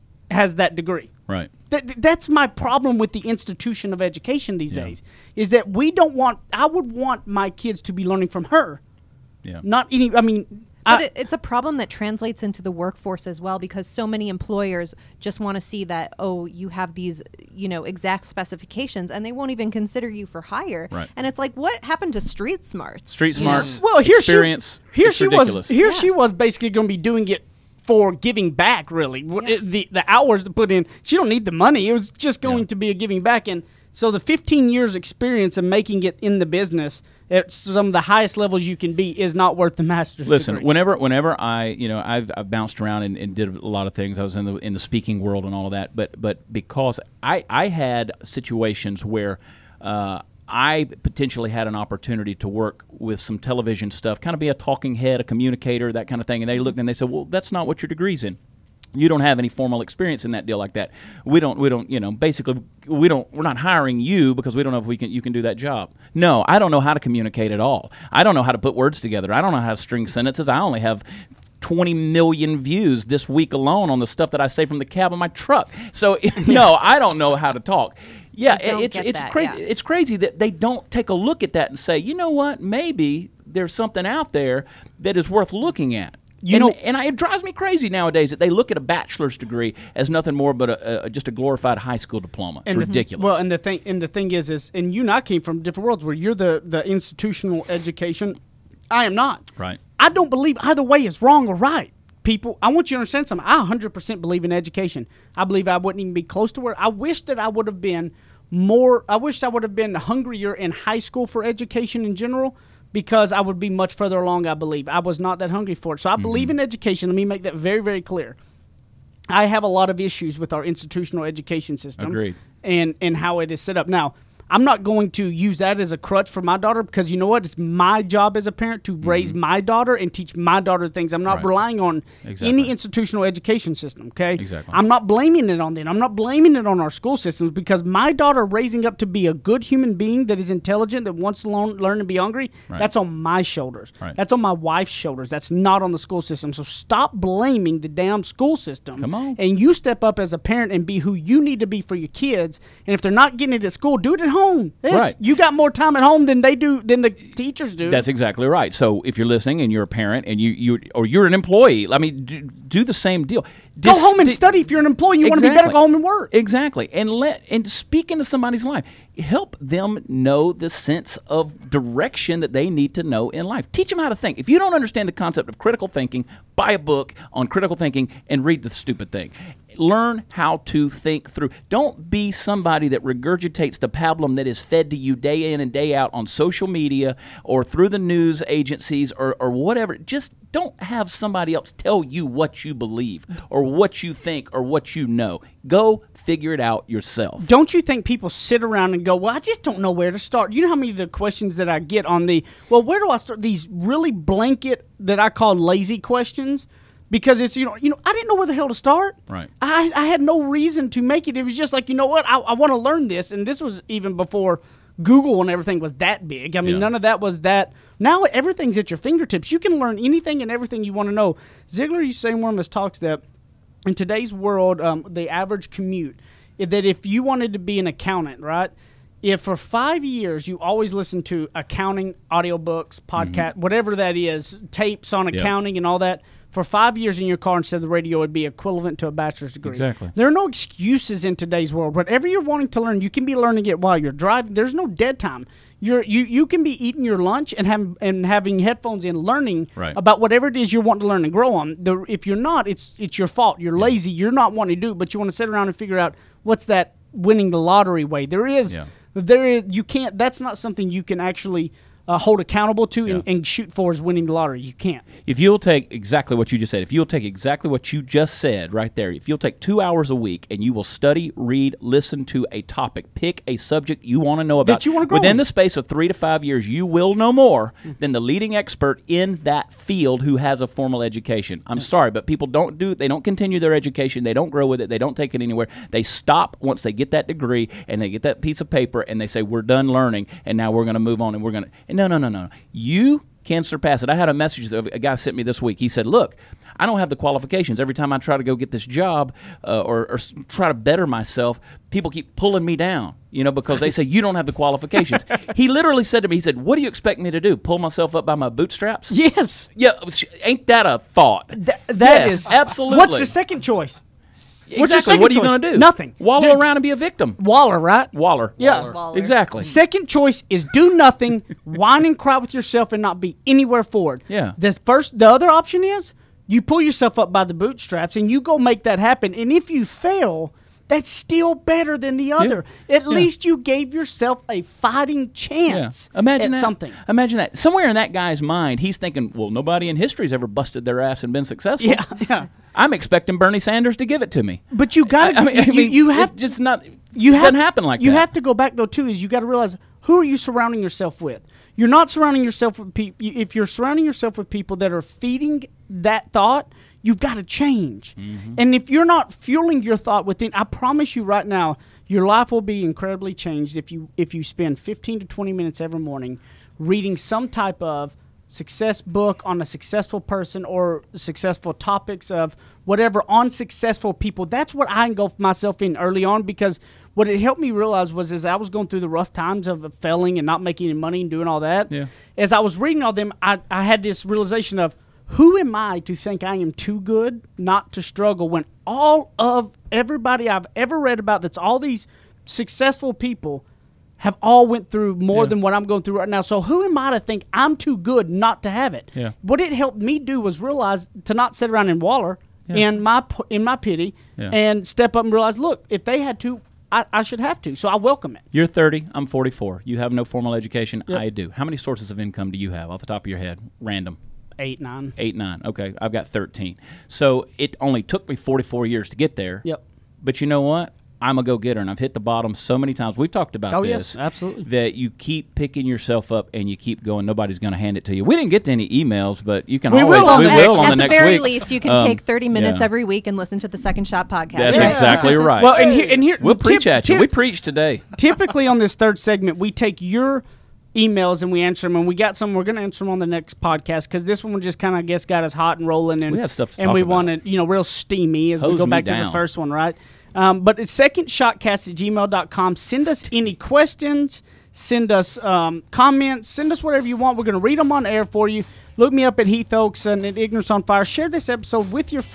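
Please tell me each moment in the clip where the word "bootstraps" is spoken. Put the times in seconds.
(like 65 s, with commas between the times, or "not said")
308 s, 327 s.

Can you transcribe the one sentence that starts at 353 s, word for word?
If you're surrounding yourself with people that are feeding that thought, you've got to change.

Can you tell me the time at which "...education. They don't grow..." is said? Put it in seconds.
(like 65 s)
283 s.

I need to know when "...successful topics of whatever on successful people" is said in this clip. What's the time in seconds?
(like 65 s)
371 s.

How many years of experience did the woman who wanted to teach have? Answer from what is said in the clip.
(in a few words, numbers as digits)
15.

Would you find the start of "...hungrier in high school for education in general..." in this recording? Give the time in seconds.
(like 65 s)
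109 s.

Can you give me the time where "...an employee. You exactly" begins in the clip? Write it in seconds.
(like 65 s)
164 s.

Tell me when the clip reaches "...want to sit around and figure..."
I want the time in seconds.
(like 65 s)
255 s.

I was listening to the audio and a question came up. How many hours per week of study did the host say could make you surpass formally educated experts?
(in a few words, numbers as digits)
2.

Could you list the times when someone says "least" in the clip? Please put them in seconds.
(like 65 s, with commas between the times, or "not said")
333 s, 431 s.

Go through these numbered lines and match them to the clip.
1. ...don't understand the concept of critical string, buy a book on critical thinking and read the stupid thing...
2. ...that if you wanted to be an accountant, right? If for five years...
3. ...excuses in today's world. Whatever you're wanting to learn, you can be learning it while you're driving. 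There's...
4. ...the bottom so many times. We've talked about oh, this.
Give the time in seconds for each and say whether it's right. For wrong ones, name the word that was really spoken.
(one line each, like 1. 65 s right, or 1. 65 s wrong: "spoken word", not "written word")
1. 174 s wrong: "thinking", not "string"
2. 226 s right
3. 240 s right
4. 422 s right.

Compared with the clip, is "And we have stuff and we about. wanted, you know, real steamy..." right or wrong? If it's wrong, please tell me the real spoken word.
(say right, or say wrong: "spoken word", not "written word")
right.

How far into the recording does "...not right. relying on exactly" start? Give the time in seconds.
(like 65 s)
131 s.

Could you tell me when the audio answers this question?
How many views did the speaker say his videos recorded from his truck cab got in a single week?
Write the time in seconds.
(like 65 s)
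71 s.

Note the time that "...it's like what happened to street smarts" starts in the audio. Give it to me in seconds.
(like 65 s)
21 s.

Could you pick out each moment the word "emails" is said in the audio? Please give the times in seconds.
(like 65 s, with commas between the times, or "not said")
428 s, 440 s.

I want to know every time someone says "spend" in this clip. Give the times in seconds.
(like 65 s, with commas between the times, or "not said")
364 s.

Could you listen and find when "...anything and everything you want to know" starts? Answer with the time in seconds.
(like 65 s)
219 s.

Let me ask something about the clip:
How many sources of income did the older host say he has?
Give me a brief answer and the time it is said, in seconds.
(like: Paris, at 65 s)
13, at 416 s.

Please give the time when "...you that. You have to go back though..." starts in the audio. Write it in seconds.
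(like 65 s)
348 s.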